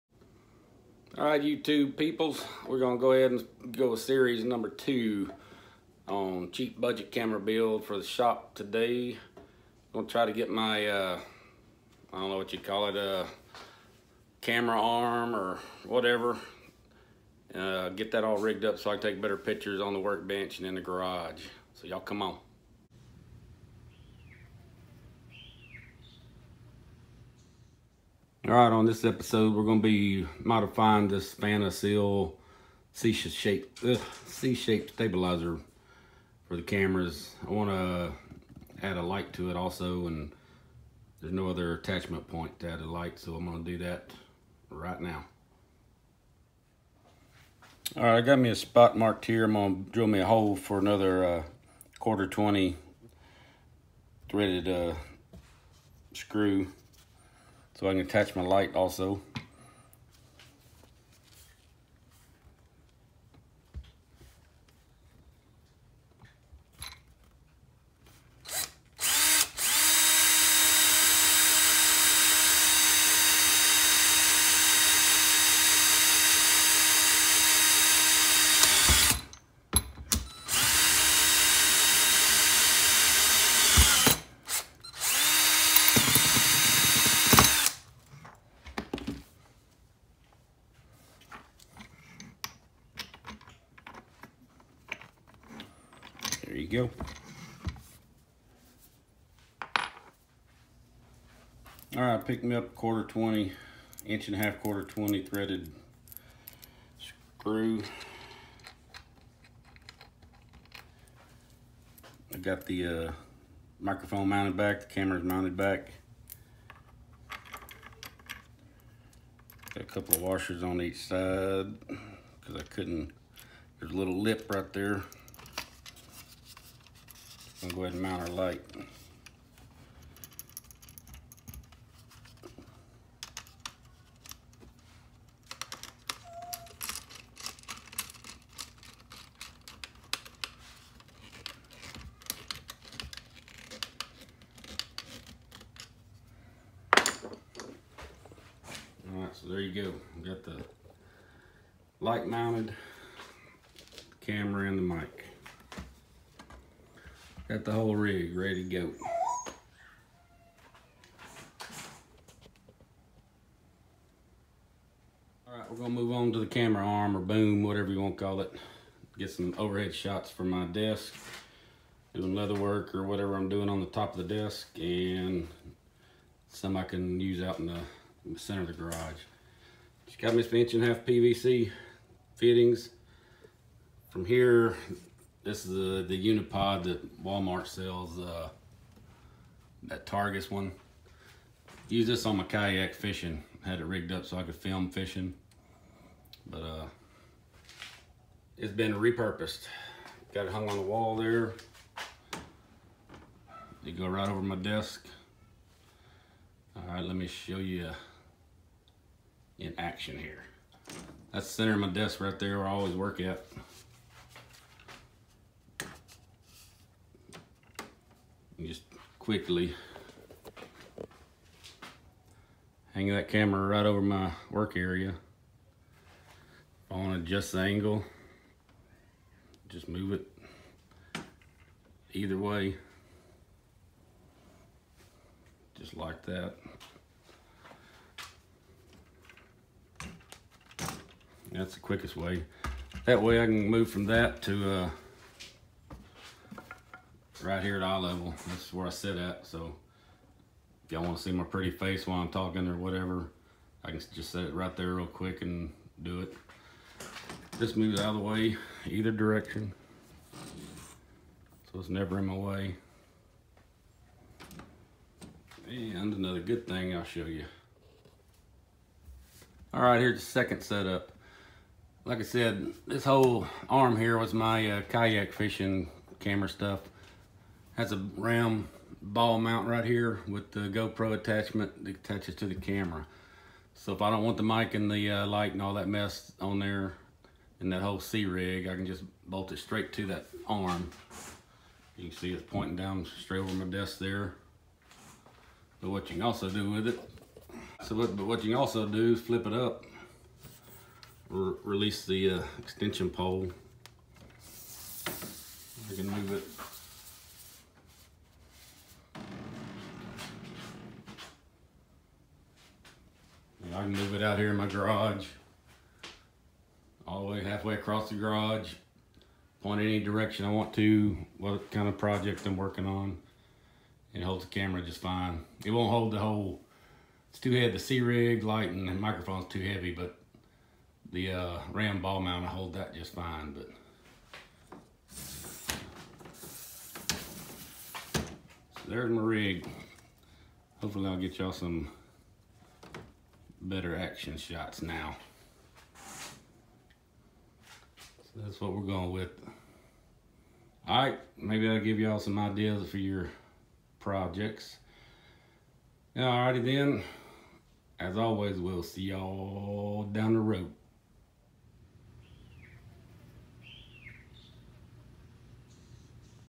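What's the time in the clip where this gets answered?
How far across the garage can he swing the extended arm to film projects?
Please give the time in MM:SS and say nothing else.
05:17.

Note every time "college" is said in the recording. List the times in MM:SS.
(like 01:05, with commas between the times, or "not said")
not said.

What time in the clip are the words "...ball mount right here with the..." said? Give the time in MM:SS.
04:39.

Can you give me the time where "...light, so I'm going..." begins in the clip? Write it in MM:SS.
00:42.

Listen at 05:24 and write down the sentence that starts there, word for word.
It holds the camera just fine.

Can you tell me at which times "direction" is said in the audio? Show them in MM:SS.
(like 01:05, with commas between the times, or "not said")
04:19, 05:19.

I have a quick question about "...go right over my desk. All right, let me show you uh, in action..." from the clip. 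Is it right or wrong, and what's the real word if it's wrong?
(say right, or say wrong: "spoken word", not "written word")
right.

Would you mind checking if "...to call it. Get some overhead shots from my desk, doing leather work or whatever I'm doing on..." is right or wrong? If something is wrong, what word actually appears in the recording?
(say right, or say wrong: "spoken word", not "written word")
right.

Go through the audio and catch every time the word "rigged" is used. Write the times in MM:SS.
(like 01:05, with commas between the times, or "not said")
00:18, 03:13.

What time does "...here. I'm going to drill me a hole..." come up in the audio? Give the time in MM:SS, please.
00:49.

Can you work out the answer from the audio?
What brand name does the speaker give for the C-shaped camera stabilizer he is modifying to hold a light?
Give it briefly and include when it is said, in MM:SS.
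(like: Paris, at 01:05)
Fanasil, at 00:31.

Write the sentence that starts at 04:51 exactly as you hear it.
You can see it's pointing down straight over my desk there.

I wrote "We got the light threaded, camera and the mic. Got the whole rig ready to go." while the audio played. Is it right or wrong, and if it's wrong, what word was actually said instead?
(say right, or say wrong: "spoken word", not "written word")
wrong: "mounted", not "threaded".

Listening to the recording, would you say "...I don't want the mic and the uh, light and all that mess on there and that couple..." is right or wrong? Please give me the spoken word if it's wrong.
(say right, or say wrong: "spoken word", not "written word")
wrong: "whole", not "couple".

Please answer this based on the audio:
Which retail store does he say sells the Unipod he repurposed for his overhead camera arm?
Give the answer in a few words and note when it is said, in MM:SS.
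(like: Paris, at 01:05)
Walmart, at 03:07.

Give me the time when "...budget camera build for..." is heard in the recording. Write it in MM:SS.
00:06.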